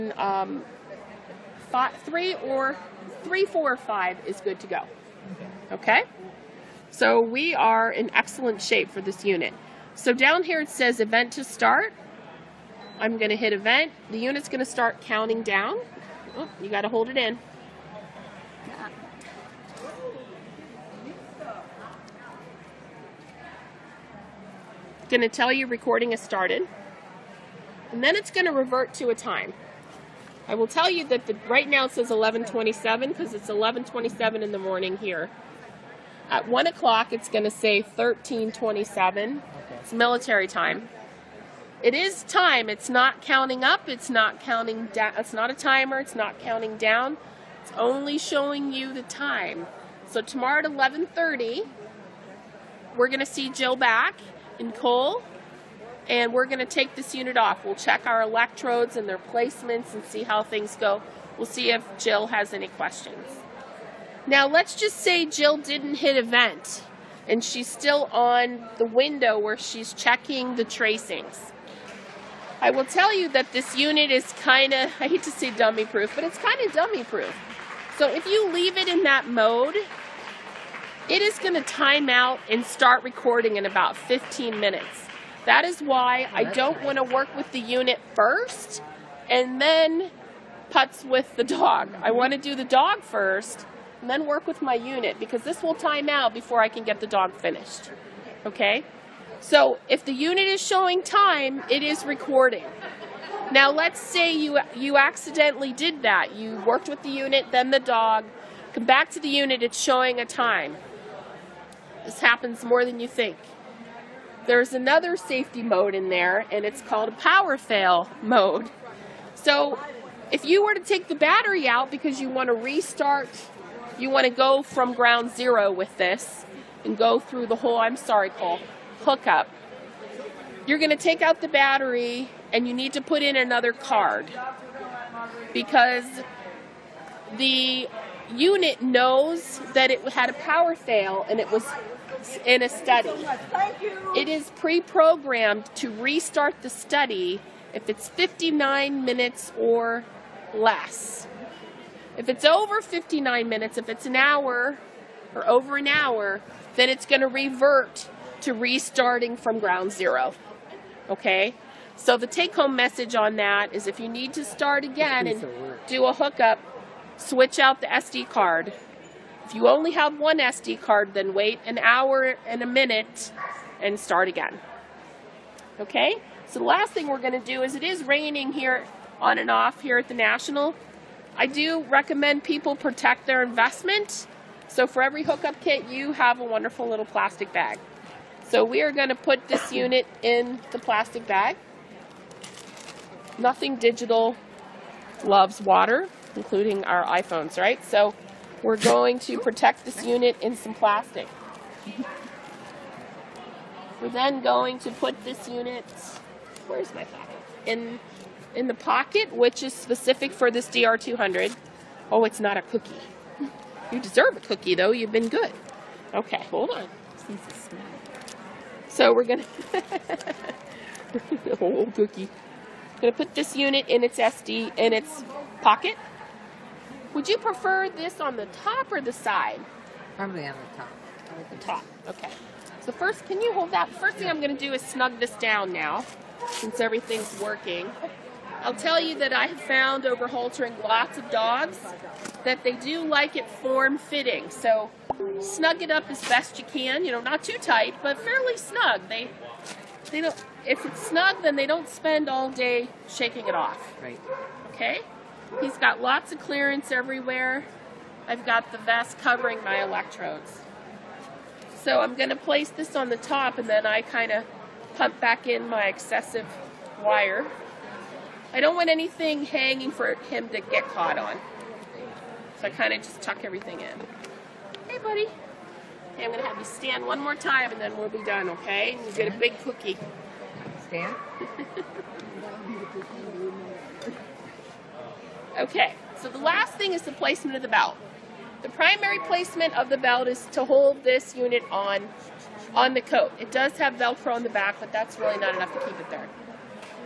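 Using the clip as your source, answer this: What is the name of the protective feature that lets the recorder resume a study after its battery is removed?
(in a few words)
power fail mode.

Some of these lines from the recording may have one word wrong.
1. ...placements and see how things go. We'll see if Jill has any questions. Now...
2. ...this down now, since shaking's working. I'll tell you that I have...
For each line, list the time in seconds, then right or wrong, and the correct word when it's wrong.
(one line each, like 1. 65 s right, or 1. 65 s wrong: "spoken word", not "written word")
1. 59 s right
2. 235 s wrong: "everything", not "shaking".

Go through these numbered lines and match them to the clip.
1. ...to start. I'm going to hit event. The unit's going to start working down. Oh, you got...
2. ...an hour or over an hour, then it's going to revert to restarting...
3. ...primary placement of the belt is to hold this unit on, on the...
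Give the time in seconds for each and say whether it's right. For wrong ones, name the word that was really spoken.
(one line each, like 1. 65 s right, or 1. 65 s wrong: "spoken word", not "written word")
1. 11 s wrong: "counting", not "working"
2. 154 s right
3. 288 s right.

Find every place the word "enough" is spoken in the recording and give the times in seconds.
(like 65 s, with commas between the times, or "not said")
295 s.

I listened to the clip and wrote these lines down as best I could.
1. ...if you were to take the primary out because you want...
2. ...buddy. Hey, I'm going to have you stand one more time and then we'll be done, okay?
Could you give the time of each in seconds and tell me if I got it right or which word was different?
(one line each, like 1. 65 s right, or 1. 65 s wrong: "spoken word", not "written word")
1. 120 s wrong: "battery", not "primary"
2. 274 s right.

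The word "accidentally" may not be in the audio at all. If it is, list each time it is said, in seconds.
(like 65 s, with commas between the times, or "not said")
104 s.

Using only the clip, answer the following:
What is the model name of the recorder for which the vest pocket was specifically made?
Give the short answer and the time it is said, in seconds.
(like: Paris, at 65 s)
DR200, at 210 s.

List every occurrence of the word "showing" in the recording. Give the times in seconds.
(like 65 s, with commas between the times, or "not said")
48 s, 100 s, 109 s.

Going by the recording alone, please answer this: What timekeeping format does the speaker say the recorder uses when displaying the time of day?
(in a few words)
military time.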